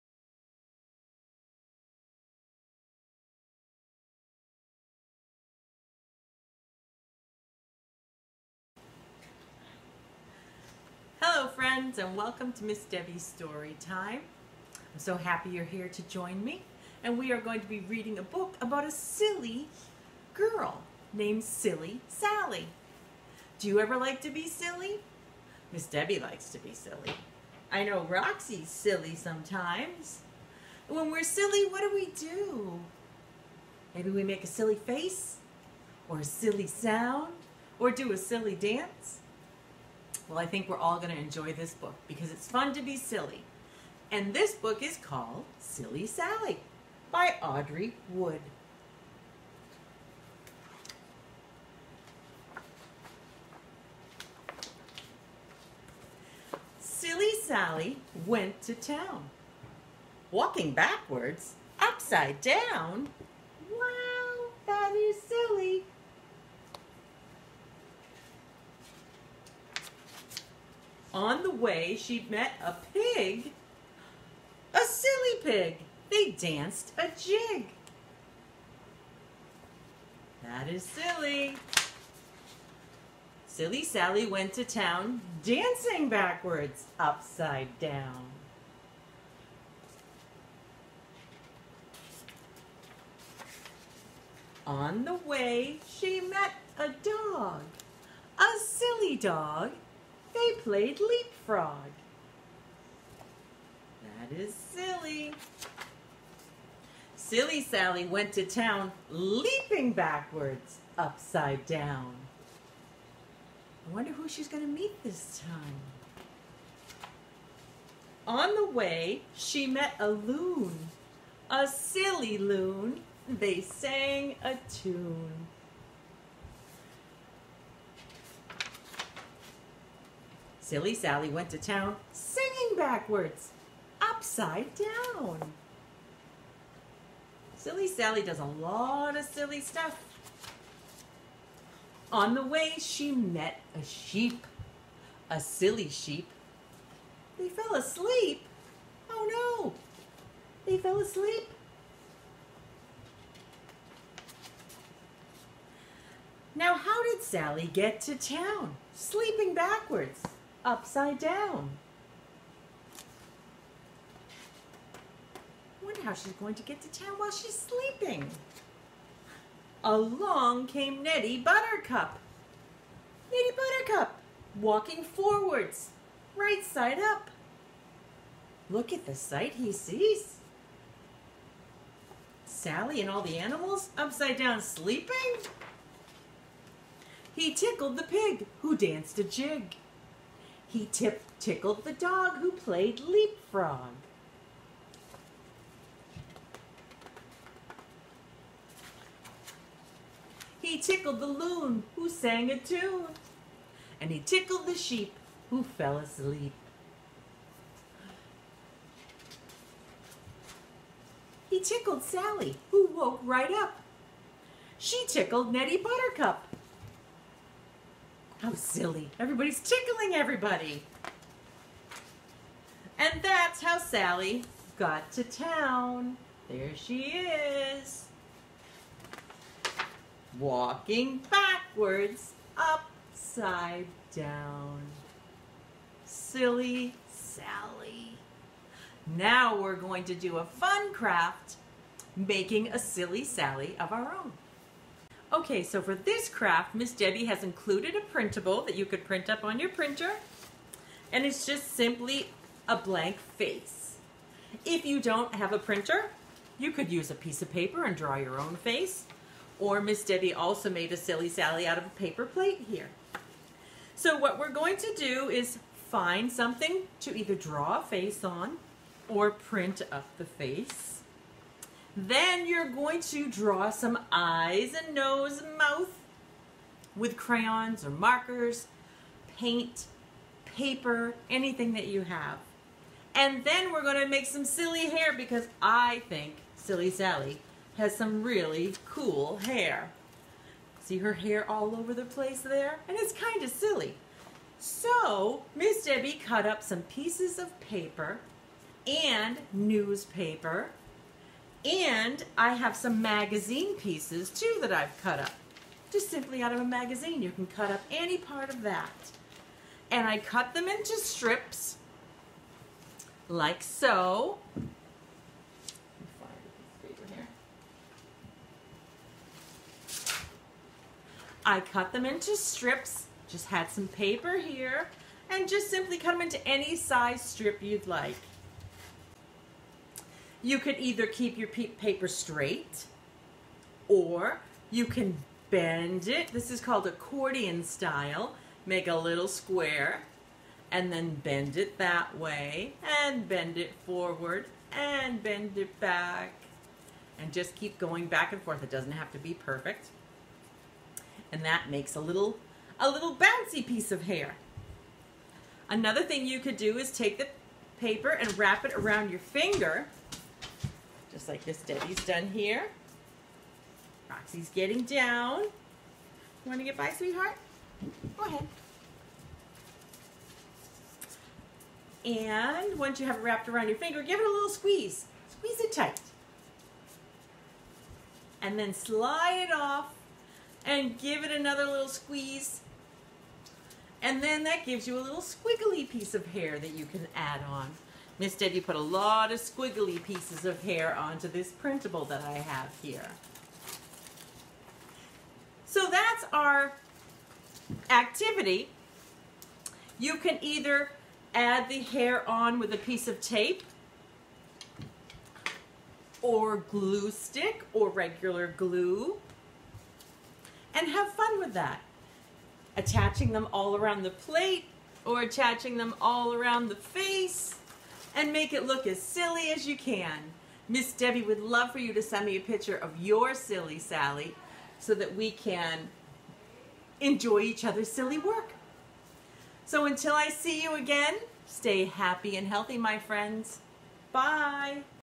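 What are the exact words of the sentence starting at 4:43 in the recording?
And then we're going to make some silly hair because I think Silly Sally has some really cool hair.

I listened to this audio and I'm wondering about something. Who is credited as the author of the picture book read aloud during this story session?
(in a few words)
Audrey Wood.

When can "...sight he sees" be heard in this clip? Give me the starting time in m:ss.
2:59.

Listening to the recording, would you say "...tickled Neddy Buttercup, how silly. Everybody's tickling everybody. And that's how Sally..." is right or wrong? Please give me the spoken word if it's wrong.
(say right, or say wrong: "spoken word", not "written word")
right.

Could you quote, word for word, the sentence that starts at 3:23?
And he tickled the sheep who fell asleep.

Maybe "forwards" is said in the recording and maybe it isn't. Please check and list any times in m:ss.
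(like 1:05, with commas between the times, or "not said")
2:55, 5:43.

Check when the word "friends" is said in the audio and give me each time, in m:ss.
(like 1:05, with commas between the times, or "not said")
0:11, 7:12.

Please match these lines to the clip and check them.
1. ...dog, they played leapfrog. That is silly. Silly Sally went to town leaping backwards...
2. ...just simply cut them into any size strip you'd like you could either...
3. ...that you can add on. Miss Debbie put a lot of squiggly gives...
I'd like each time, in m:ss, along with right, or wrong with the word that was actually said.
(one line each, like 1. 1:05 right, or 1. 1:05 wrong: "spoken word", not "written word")
1. 1:39 right
2. 5:25 right
3. 6:26 wrong: "pieces", not "gives".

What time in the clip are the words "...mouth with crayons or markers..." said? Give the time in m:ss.
4:35.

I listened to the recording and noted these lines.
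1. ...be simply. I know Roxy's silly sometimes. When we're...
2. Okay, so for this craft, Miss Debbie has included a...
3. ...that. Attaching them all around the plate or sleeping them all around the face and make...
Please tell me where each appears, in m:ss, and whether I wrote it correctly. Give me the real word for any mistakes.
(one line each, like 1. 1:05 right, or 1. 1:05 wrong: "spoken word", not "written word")
1. 0:26 wrong: "silly", not "simply"
2. 4:05 right
3. 6:51 wrong: "attaching", not "sleeping".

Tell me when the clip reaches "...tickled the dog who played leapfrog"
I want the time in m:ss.
3:11.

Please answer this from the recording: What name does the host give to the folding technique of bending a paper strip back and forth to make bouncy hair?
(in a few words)
accordion style.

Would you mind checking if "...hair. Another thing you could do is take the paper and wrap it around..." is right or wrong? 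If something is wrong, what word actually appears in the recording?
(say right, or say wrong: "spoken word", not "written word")
right.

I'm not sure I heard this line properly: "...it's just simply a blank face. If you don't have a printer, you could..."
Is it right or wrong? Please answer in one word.
right.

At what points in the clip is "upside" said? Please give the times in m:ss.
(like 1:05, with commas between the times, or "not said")
1:01, 1:26, 1:50, 2:14, 2:40, 3:03, 3:52.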